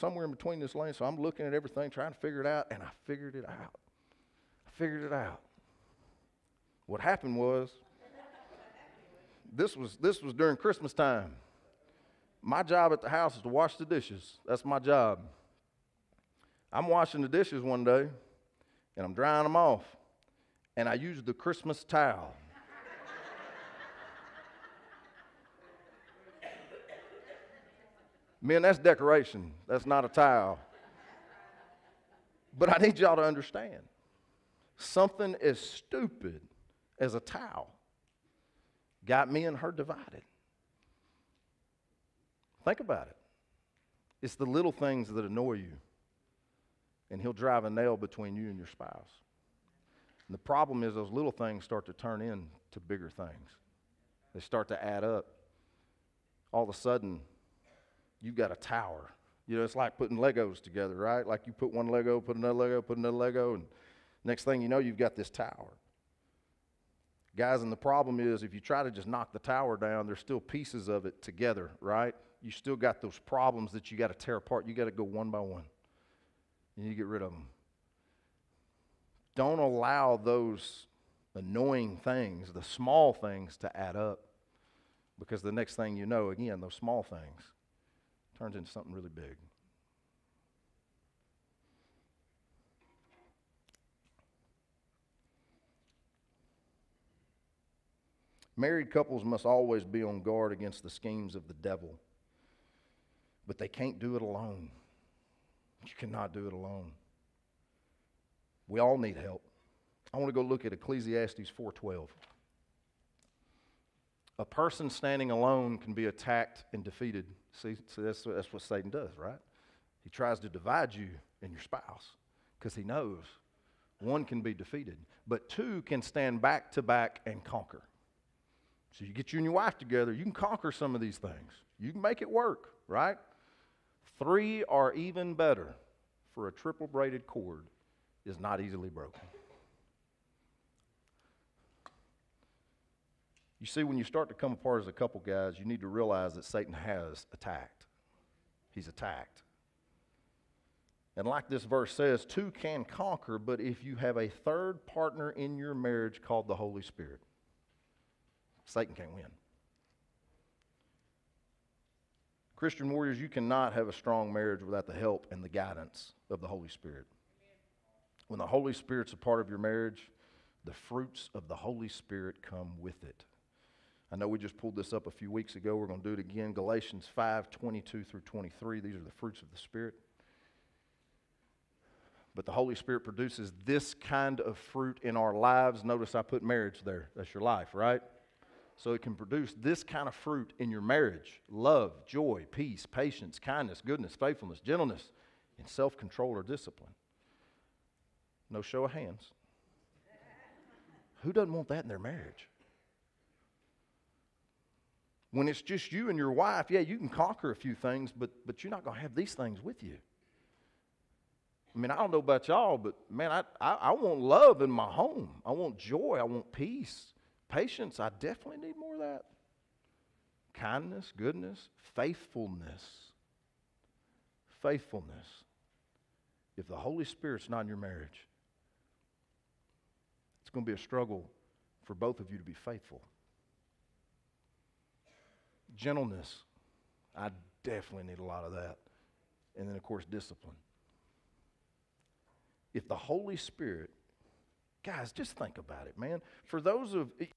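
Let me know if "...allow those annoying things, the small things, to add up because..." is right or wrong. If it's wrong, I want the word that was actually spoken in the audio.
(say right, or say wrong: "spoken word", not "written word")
right.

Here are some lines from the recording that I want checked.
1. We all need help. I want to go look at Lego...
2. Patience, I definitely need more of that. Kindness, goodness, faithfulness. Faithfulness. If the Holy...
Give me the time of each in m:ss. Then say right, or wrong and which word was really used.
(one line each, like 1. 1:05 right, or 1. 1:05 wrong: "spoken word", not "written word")
1. 1:48 wrong: "Ecclesiastes", not "Lego"
2. 3:37 right.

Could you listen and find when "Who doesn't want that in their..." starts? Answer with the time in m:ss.
3:21.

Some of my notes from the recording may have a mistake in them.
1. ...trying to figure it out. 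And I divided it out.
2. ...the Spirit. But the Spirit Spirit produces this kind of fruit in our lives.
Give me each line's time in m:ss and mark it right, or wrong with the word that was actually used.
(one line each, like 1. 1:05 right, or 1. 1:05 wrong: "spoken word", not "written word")
1. 0:01 wrong: "figured", not "divided"
2. 2:59 wrong: "Holy", not "Spirit".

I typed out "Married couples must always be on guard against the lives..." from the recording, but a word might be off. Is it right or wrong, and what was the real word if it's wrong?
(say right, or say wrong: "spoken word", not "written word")
wrong: "schemes", not "lives".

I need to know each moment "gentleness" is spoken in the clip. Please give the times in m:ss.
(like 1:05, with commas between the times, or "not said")
3:14, 3:55.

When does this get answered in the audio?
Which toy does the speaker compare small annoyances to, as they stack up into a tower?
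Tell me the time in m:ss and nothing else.
1:00.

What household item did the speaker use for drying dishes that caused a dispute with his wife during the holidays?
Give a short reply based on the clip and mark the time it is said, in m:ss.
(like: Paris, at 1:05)
Christmas towel, at 0:21.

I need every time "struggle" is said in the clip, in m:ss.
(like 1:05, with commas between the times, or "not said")
3:50.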